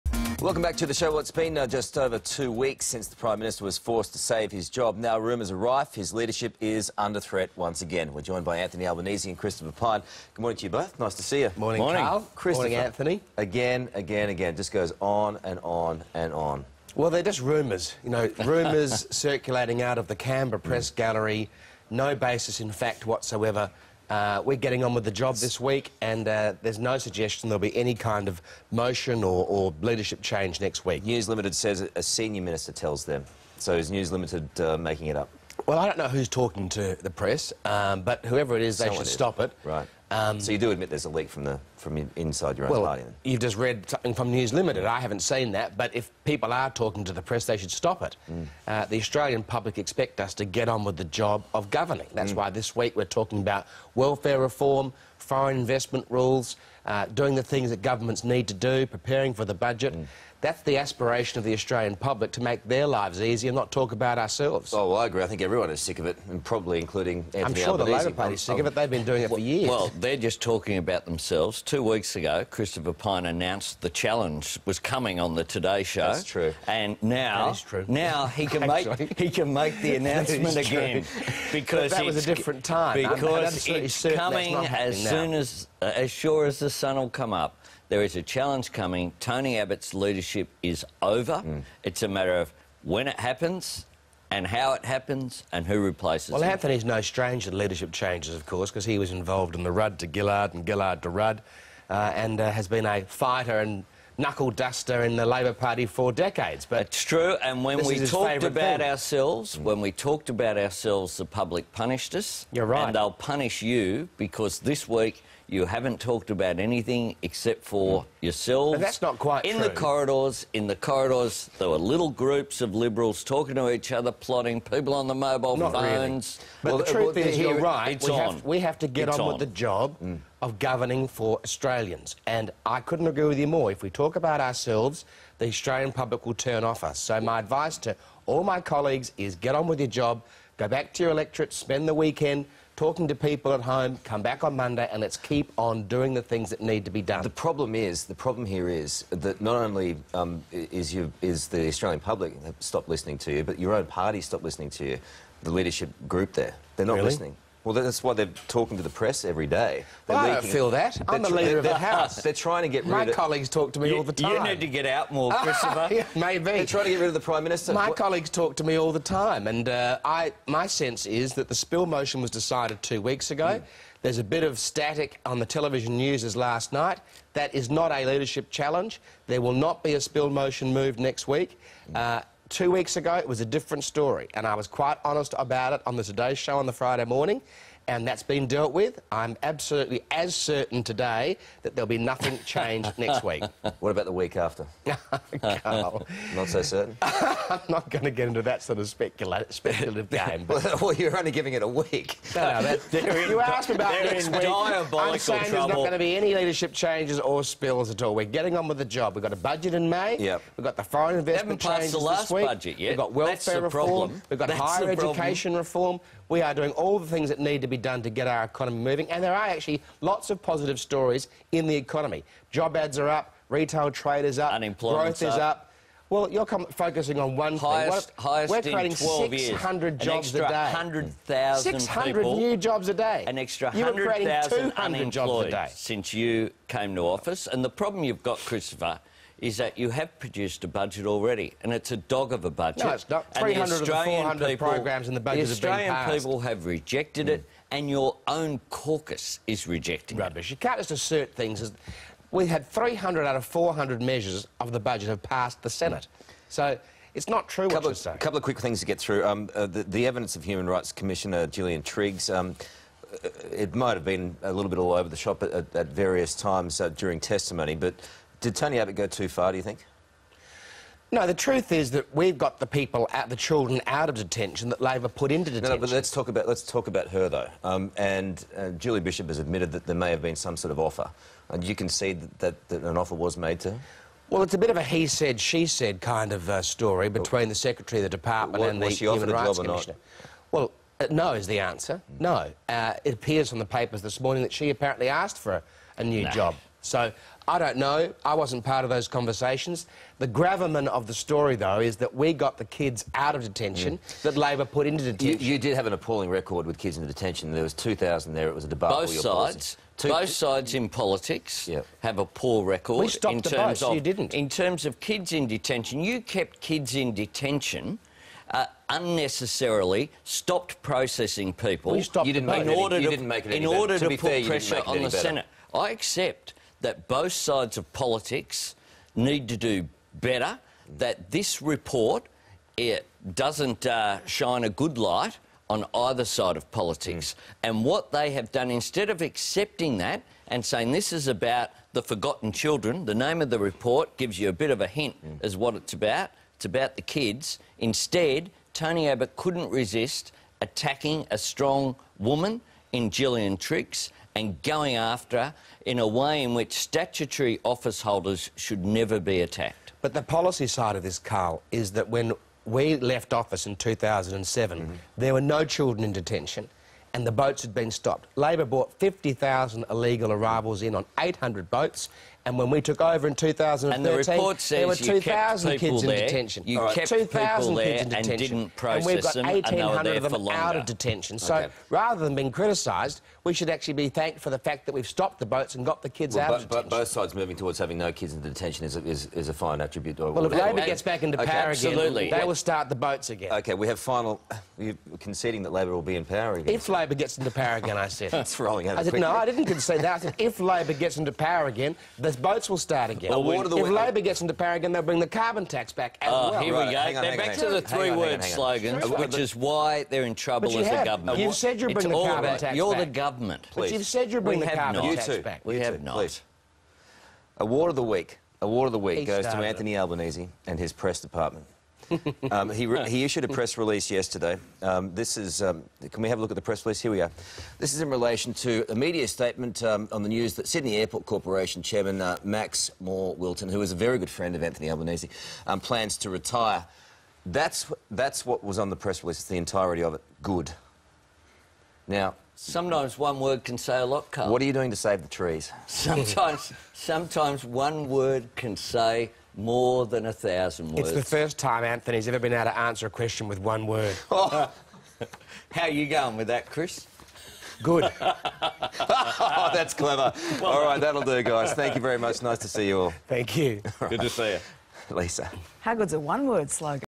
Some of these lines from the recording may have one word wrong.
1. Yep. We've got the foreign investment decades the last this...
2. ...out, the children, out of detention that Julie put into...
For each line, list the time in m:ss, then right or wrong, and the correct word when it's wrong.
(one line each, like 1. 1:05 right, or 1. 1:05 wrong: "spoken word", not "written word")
1. 3:30 wrong: "changes", not "decades"
2. 4:33 wrong: "Labor", not "Julie".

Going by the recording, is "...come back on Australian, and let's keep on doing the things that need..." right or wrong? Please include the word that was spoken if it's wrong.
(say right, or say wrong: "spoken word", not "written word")
wrong: "Monday", not "Australian".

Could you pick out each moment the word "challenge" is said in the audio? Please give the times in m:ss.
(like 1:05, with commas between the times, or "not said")
1:13, 1:28, 2:58.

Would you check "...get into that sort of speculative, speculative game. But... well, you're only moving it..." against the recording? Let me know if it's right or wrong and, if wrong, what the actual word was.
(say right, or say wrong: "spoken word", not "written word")
wrong: "giving", not "moving".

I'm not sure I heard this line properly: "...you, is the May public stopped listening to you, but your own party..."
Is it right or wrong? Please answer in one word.
wrong.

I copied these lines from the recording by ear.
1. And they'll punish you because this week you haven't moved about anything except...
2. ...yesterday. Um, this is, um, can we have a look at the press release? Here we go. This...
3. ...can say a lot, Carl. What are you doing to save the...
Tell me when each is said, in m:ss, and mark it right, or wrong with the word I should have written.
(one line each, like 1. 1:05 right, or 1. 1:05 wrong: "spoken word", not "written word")
1. 1:52 wrong: "talked", not "moved"
2. 7:04 right
3. 7:23 right.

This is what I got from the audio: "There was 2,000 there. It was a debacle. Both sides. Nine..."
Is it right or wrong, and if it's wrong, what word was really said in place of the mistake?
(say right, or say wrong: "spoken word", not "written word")
wrong: "Two", not "Nine".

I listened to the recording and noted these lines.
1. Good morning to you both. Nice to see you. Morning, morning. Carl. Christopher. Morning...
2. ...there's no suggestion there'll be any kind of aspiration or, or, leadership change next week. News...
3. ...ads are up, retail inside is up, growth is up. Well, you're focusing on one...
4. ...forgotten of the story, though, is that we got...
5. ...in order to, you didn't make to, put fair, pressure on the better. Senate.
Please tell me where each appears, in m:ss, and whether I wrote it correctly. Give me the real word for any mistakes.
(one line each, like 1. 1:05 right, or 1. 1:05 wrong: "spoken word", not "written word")
1. 0:10 right
2. 0:26 wrong: "motion", not "aspiration"
3. 3:42 wrong: "trade", not "inside"
4. 5:00 wrong: "gravamen", not "forgotten"
5. 5:22 right.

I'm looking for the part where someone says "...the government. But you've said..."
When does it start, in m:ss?
6:52.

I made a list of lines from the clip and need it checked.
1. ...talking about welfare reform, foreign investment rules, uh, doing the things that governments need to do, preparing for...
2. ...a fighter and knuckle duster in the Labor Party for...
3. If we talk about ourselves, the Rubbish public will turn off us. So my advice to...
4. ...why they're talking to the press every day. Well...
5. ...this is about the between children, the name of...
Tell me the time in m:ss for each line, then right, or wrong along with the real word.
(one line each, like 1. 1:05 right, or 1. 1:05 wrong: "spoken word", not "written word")
1. 0:53 right
2. 1:42 right
3. 2:13 wrong: "Australian", not "Rubbish"
4. 2:38 right
5. 5:40 wrong: "forgotten", not "between".